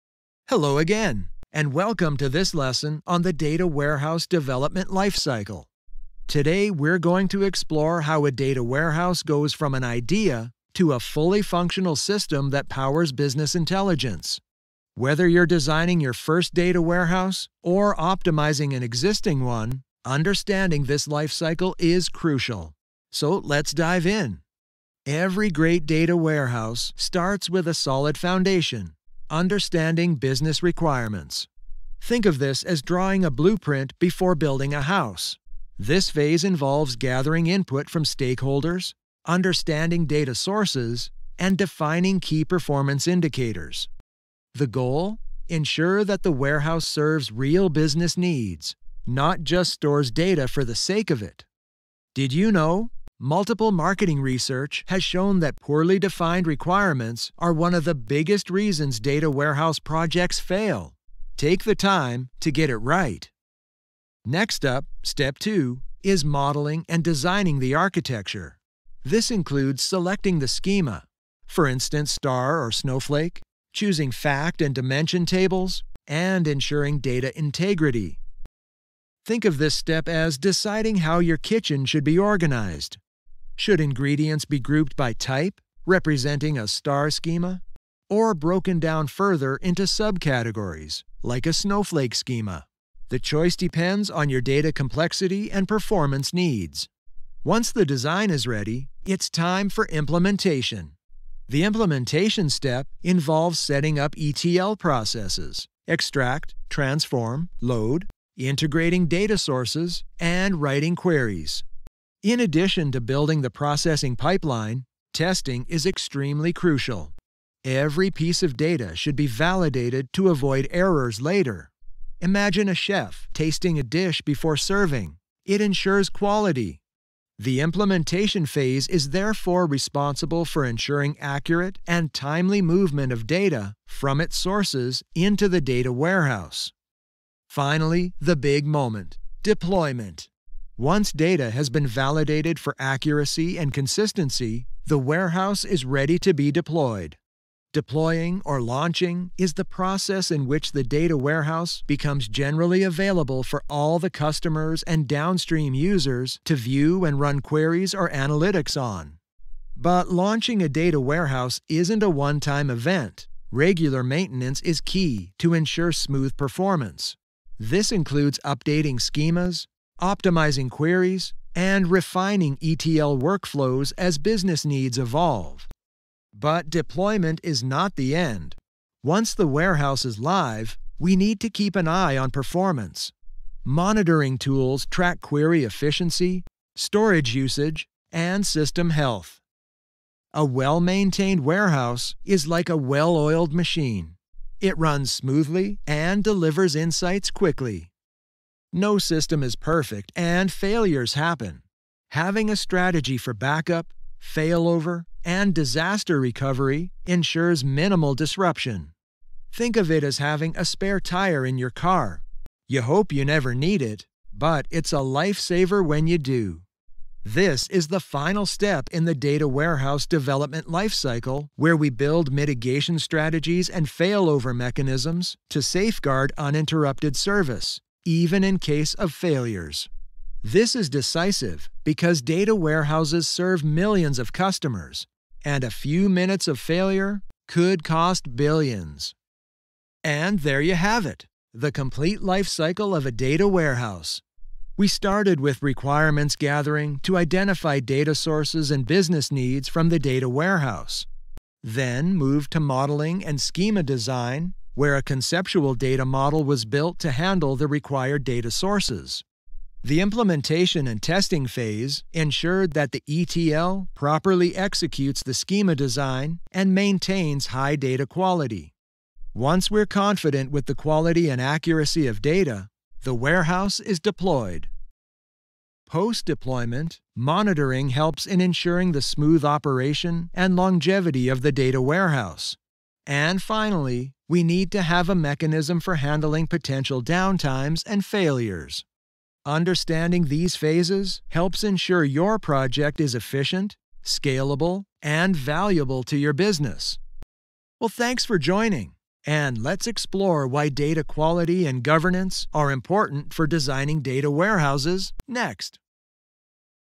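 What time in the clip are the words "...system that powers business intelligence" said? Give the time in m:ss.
0:11.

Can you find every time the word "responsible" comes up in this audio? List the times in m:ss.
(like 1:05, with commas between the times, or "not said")
2:09.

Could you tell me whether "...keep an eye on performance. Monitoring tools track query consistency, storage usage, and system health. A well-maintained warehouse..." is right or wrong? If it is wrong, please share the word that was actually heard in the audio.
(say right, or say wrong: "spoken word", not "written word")
wrong: "efficiency", not "consistency".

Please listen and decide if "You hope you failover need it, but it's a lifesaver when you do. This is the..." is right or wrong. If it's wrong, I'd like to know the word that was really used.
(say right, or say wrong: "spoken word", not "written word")
wrong: "never", not "failover".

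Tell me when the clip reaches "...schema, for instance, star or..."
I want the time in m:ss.
1:10.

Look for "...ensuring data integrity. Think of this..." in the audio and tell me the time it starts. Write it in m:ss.
1:16.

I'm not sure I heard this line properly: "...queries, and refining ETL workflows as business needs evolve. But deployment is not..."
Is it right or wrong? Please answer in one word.
right.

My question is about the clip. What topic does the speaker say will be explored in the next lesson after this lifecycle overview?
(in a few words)
Data quality and governance.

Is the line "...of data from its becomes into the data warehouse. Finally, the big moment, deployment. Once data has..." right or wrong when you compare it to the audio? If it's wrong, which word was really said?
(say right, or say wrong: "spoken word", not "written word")
wrong: "sources", not "becomes".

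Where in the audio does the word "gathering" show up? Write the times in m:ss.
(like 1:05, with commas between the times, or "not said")
0:36, 4:06.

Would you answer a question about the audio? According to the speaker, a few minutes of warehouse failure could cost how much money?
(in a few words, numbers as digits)
Billions.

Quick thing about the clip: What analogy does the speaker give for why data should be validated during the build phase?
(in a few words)
A chef tasting a dish.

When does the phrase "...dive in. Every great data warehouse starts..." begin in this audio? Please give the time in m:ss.
0:23.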